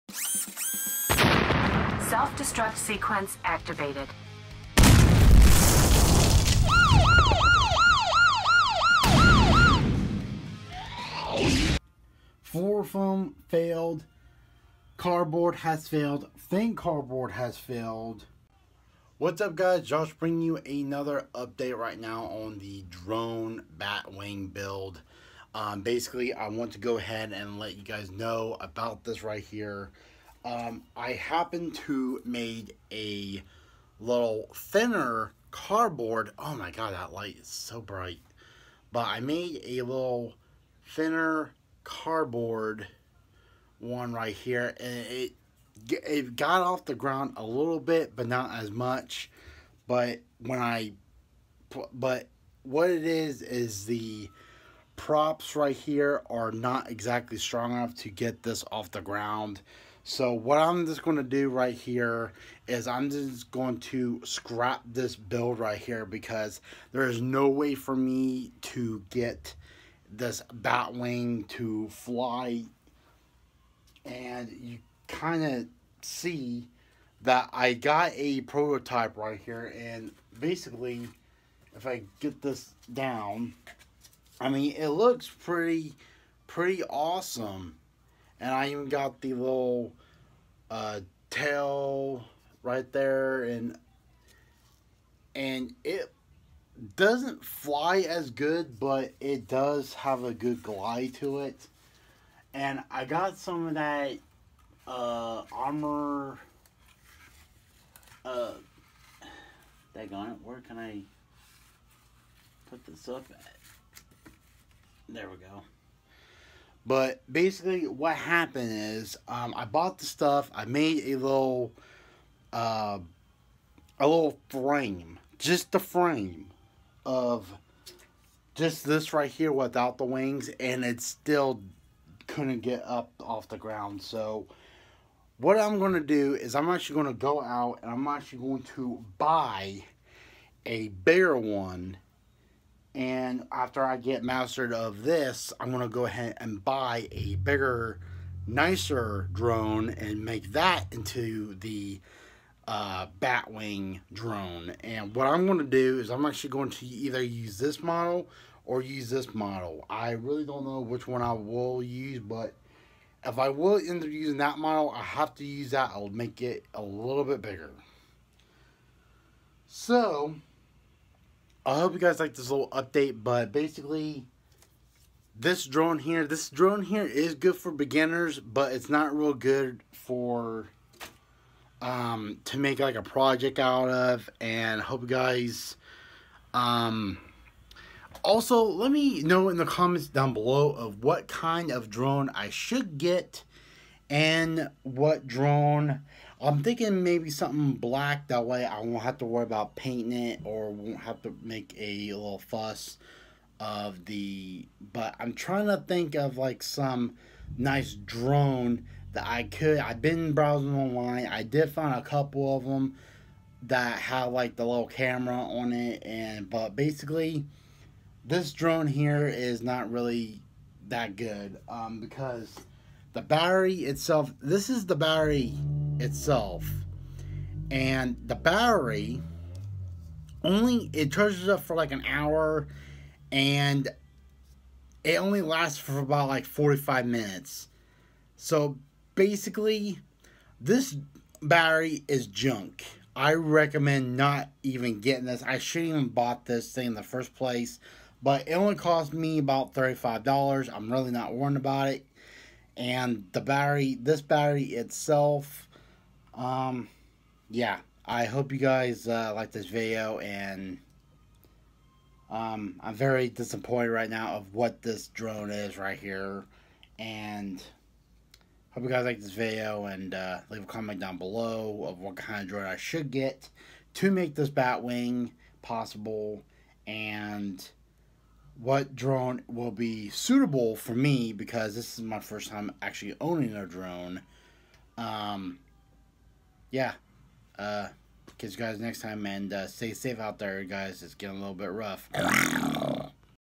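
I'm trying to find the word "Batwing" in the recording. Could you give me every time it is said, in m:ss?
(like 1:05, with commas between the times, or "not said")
0:23, 1:10, 2:33, 4:34.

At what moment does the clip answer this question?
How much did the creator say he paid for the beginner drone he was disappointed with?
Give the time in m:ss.
4:09.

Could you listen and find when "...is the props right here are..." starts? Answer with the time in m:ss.
0:53.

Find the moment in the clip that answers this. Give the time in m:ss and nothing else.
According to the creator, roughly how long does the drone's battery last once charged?
3:56.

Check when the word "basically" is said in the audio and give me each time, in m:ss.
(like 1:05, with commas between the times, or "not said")
0:25, 1:20, 1:57, 2:53, 3:36, 3:59.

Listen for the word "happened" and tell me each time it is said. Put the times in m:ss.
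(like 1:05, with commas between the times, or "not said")
0:31, 1:58.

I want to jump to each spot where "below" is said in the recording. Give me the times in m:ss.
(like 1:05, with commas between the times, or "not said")
3:10, 4:31.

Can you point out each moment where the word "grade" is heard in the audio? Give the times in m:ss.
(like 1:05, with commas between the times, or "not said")
not said.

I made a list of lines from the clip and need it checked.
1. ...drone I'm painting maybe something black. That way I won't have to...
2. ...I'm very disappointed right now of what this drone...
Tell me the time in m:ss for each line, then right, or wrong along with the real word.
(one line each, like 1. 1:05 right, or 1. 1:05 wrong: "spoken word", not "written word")
1. 3:15 wrong: "thinking", not "painting"
2. 4:22 right.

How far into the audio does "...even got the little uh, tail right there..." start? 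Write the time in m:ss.
1:28.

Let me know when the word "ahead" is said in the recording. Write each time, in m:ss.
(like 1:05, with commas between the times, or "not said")
0:26, 2:26.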